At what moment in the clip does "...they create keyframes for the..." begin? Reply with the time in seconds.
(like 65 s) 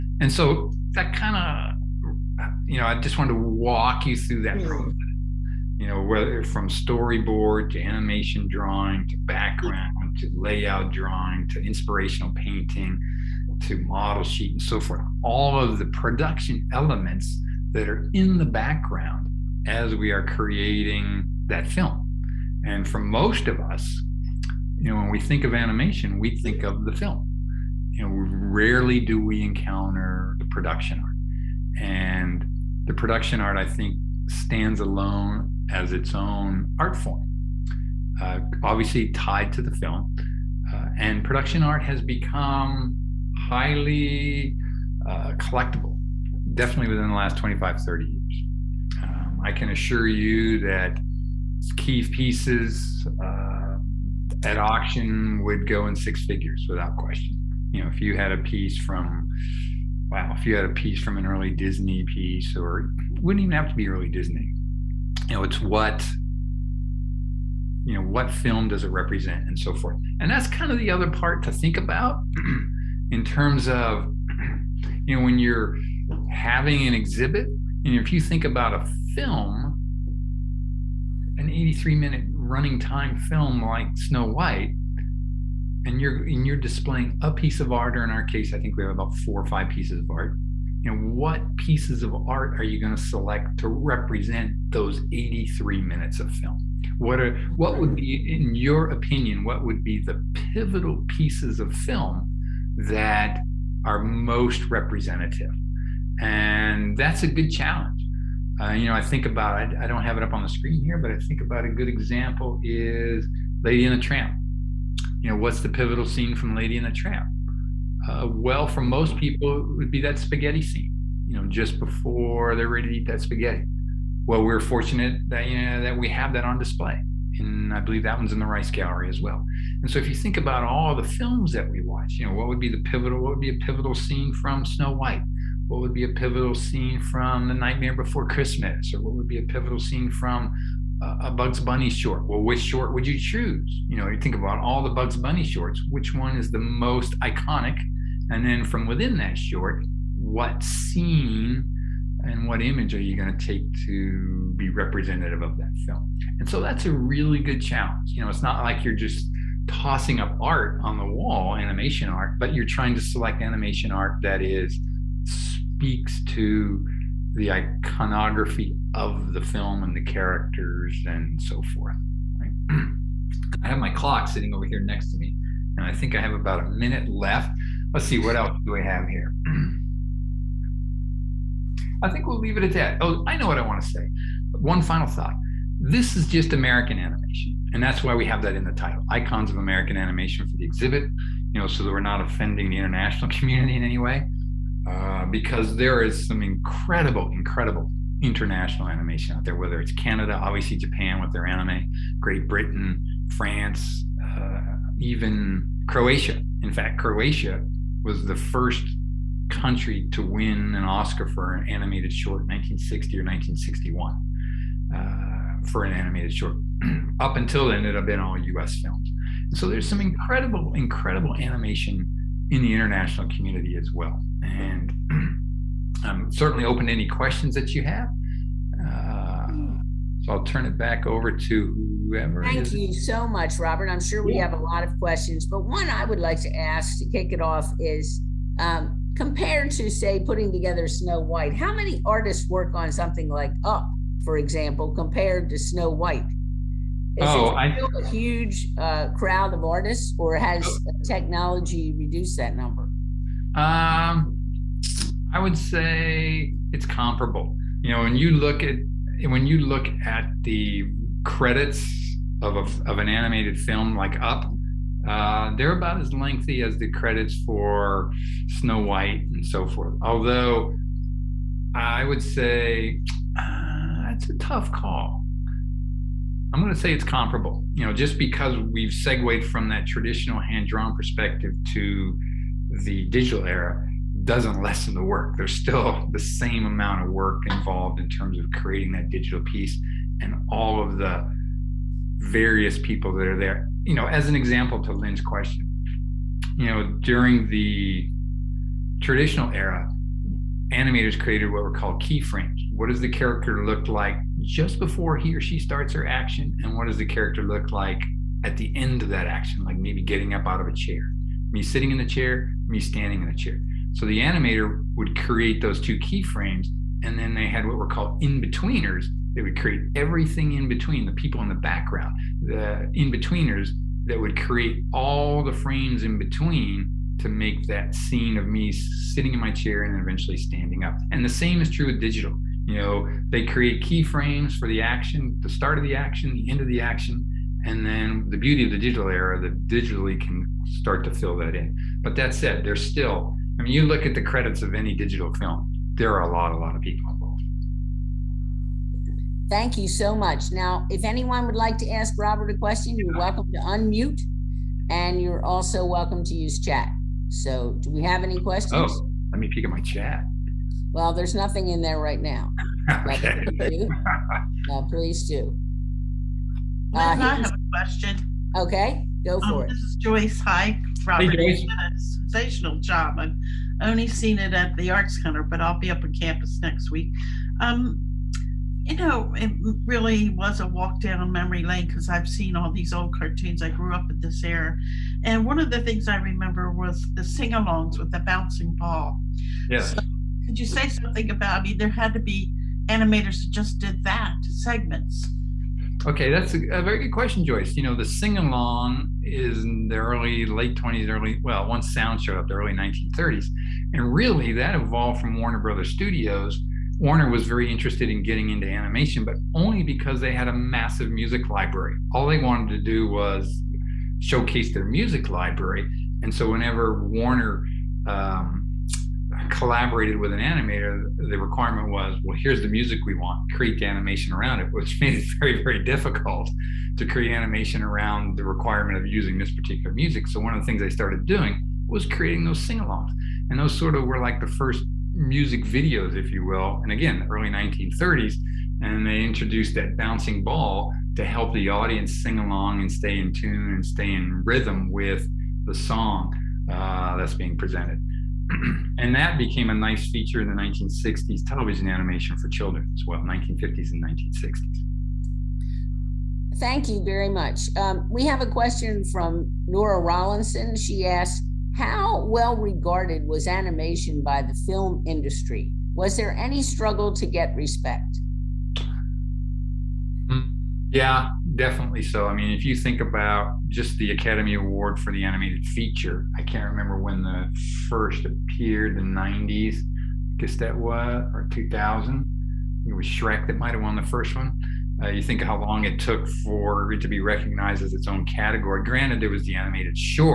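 333 s.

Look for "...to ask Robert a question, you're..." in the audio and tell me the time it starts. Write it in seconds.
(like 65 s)
351 s.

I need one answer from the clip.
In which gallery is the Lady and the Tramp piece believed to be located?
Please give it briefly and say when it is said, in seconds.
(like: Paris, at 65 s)
Rice Gallery, at 128 s.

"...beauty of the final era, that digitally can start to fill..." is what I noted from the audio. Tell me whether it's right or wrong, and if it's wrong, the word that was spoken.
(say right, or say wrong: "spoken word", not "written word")
wrong: "digital", not "final".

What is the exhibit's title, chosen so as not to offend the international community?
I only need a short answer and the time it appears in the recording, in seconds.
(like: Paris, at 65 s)
Icons of American Animation, at 189 s.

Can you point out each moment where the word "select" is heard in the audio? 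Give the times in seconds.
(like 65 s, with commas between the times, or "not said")
93 s, 163 s.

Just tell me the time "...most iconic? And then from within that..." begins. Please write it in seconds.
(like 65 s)
146 s.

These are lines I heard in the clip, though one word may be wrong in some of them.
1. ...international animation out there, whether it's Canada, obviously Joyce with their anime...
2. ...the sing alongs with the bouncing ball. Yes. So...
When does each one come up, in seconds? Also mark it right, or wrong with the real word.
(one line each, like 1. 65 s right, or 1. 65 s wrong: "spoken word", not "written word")
1. 198 s wrong: "Japan", not "Joyce"
2. 387 s right.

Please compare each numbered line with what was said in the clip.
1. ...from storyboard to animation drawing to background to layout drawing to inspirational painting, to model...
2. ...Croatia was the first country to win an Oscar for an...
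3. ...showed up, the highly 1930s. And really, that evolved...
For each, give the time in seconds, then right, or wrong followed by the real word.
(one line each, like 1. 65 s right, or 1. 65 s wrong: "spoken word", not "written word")
1. 6 s right
2. 206 s right
3. 402 s wrong: "early", not "highly".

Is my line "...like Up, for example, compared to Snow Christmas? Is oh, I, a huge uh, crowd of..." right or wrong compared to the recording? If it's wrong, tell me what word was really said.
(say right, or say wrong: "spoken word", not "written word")
wrong: "White", not "Christmas".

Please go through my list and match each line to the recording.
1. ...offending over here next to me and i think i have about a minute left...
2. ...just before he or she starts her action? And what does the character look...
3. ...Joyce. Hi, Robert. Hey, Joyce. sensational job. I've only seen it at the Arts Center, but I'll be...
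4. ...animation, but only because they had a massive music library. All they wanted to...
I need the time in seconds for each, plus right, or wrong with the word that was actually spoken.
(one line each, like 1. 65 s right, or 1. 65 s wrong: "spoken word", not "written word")
1. 174 s wrong: "sitting", not "offending"
2. 304 s right
3. 370 s right
4. 408 s right.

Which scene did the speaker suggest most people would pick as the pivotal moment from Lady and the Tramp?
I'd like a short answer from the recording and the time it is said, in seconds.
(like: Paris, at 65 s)
spaghetti scene, at 120 s.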